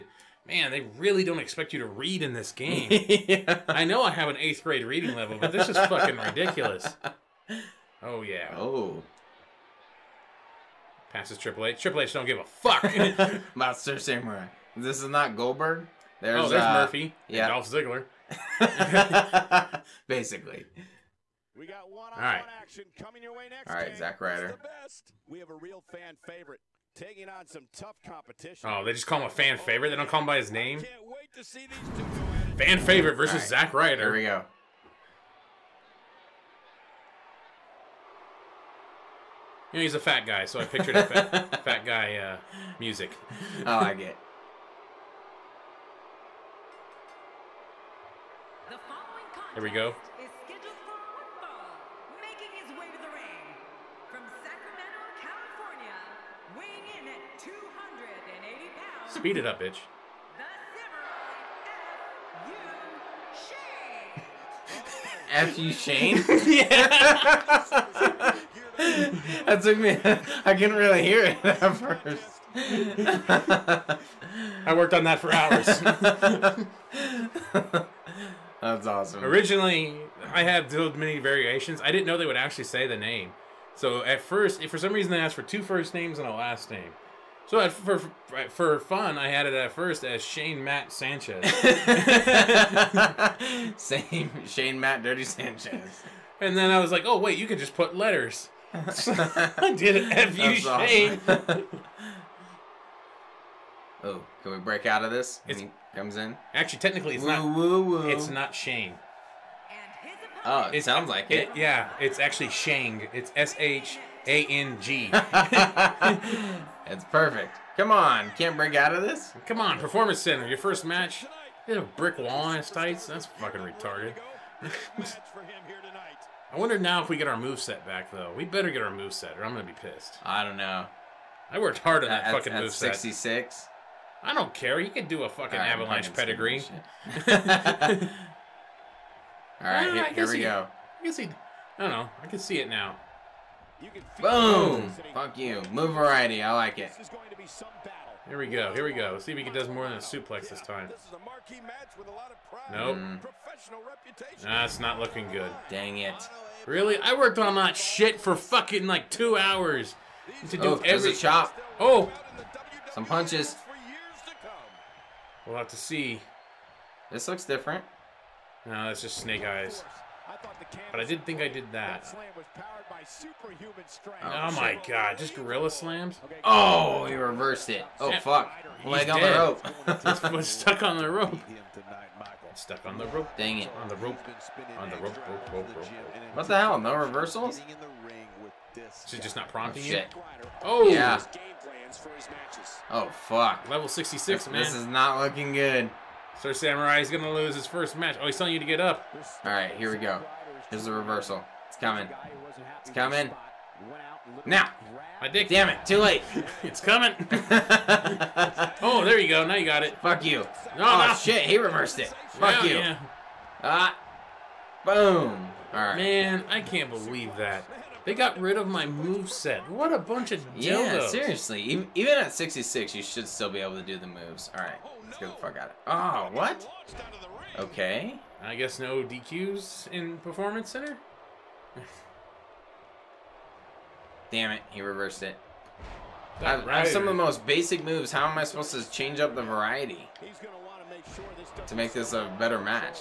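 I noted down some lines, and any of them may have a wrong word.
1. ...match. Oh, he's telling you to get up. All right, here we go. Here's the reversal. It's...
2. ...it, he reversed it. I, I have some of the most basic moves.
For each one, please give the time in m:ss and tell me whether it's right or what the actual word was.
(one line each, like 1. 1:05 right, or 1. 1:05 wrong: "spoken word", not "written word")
1. 3:17 right
2. 3:54 right.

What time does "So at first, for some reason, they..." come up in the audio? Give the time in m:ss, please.
1:23.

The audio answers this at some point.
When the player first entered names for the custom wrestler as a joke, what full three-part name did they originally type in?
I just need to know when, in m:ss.
1:30.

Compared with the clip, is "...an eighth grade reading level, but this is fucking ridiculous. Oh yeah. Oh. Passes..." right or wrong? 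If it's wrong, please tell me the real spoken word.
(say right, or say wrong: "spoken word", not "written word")
right.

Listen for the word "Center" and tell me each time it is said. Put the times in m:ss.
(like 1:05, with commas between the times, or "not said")
2:00, 3:50.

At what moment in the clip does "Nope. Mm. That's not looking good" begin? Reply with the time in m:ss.
2:32.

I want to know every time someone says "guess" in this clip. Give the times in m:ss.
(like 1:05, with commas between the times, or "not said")
2:21, 3:48.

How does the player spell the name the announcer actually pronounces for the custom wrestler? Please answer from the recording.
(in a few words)
SHANG.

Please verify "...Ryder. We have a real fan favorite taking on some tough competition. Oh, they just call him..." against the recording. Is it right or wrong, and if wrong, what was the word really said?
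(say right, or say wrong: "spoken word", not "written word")
right.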